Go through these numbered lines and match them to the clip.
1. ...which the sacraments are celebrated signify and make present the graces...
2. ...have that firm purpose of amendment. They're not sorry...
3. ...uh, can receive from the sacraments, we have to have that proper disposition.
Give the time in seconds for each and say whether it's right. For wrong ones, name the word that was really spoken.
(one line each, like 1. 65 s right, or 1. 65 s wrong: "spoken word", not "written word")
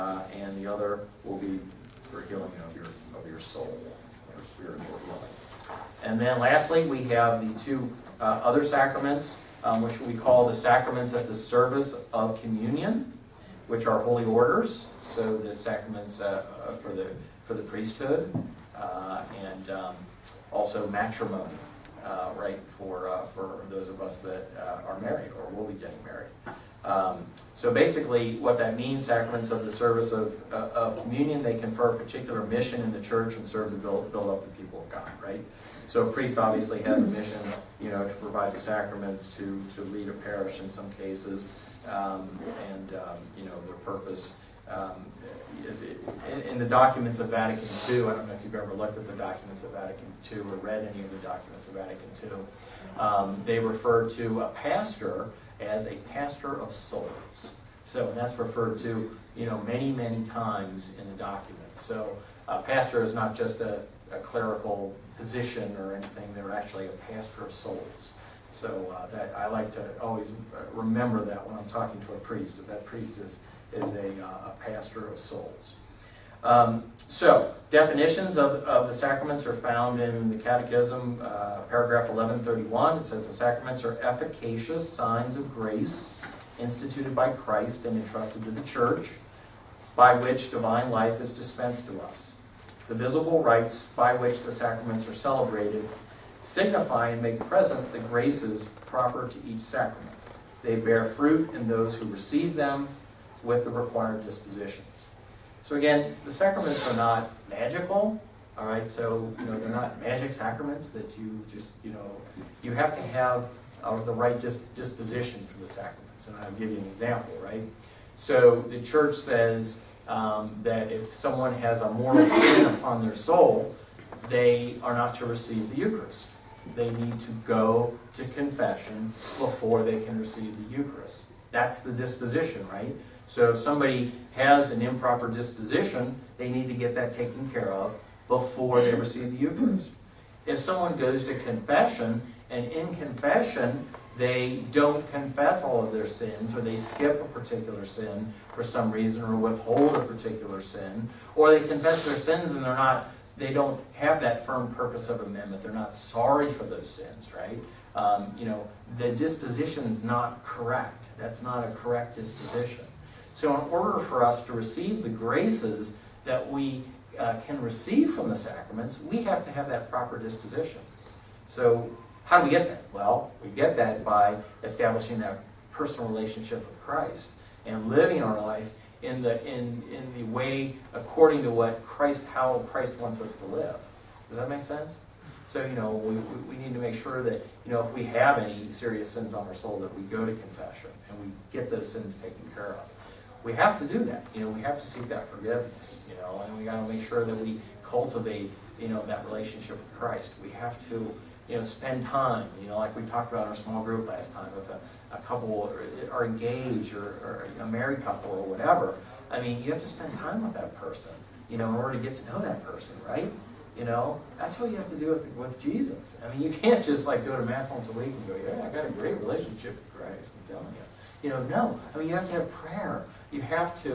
1. 94 s right
2. 153 s right
3. 167 s right.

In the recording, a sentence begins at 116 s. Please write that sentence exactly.
And I'll give you an example, right?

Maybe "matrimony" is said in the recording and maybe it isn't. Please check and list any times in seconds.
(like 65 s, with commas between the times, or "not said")
20 s.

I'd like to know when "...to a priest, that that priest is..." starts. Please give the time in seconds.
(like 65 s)
72 s.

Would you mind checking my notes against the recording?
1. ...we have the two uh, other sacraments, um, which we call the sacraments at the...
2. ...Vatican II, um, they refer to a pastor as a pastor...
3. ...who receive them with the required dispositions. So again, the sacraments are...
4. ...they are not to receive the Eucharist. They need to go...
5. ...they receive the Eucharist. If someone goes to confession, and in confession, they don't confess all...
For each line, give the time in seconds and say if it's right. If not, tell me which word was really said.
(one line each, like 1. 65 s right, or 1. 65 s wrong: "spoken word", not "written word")
1. 6 s right
2. 51 s right
3. 101 s right
4. 124 s right
5. 138 s right.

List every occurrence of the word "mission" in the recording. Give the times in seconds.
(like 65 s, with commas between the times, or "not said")
32 s, 37 s.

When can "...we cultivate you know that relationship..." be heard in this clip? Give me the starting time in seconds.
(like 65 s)
197 s.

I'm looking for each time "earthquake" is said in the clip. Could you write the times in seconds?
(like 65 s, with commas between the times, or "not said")
not said.